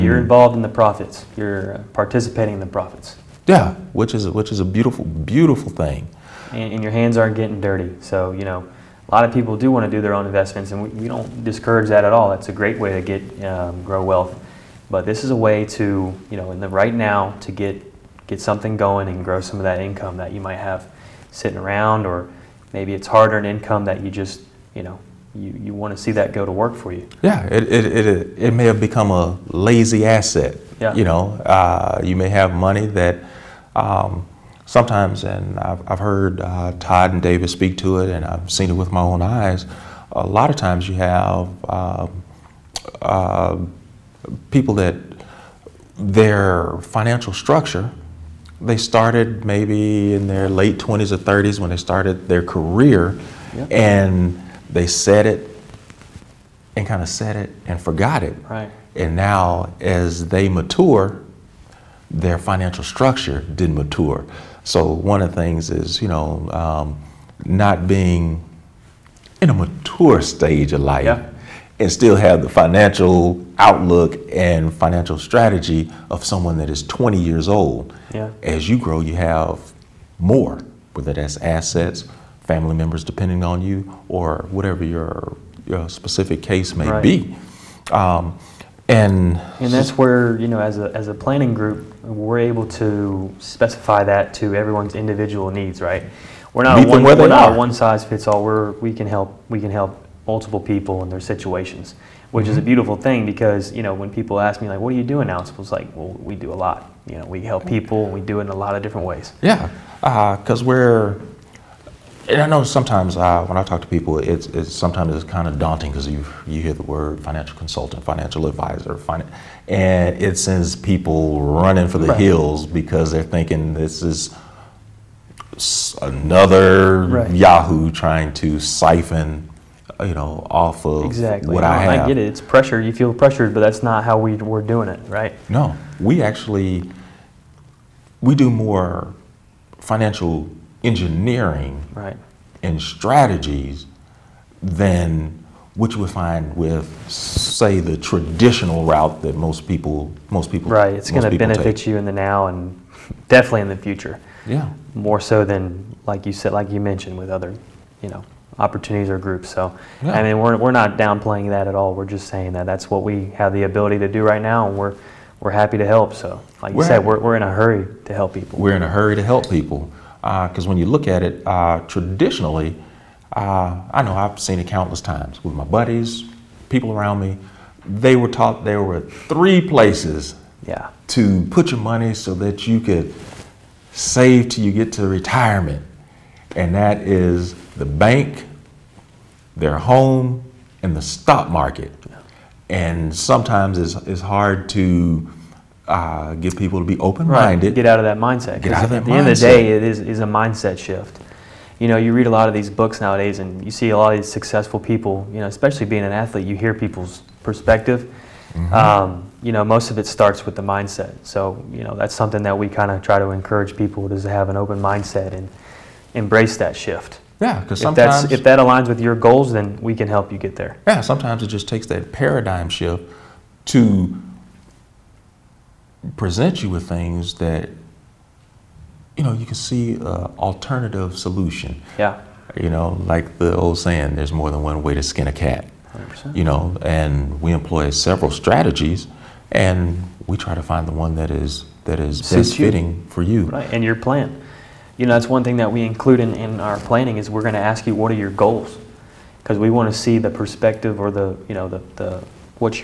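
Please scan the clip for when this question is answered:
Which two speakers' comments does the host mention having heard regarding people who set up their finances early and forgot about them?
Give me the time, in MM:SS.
00:36.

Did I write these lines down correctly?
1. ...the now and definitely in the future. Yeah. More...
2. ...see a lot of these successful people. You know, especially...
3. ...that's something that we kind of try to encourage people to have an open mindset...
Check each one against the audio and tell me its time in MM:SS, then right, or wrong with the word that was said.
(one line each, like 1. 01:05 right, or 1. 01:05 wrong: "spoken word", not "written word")
1. 02:32 right
2. 03:23 right
3. 03:31 right.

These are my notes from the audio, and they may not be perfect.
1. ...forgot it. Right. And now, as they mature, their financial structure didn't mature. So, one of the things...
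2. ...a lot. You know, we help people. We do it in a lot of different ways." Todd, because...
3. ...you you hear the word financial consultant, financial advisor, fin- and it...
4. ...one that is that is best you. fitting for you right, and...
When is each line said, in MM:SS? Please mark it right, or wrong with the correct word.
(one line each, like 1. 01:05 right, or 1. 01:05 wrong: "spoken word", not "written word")
1. 00:57 right
2. 01:46 wrong: "Yeah", not "Todd"
3. 01:56 right
4. 04:00 right.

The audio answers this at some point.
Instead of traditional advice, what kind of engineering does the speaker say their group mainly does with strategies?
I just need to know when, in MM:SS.
02:19.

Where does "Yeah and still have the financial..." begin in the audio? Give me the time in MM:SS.
01:11.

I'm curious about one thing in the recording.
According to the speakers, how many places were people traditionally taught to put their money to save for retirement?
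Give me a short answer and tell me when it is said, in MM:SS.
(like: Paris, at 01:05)
3, at 02:59.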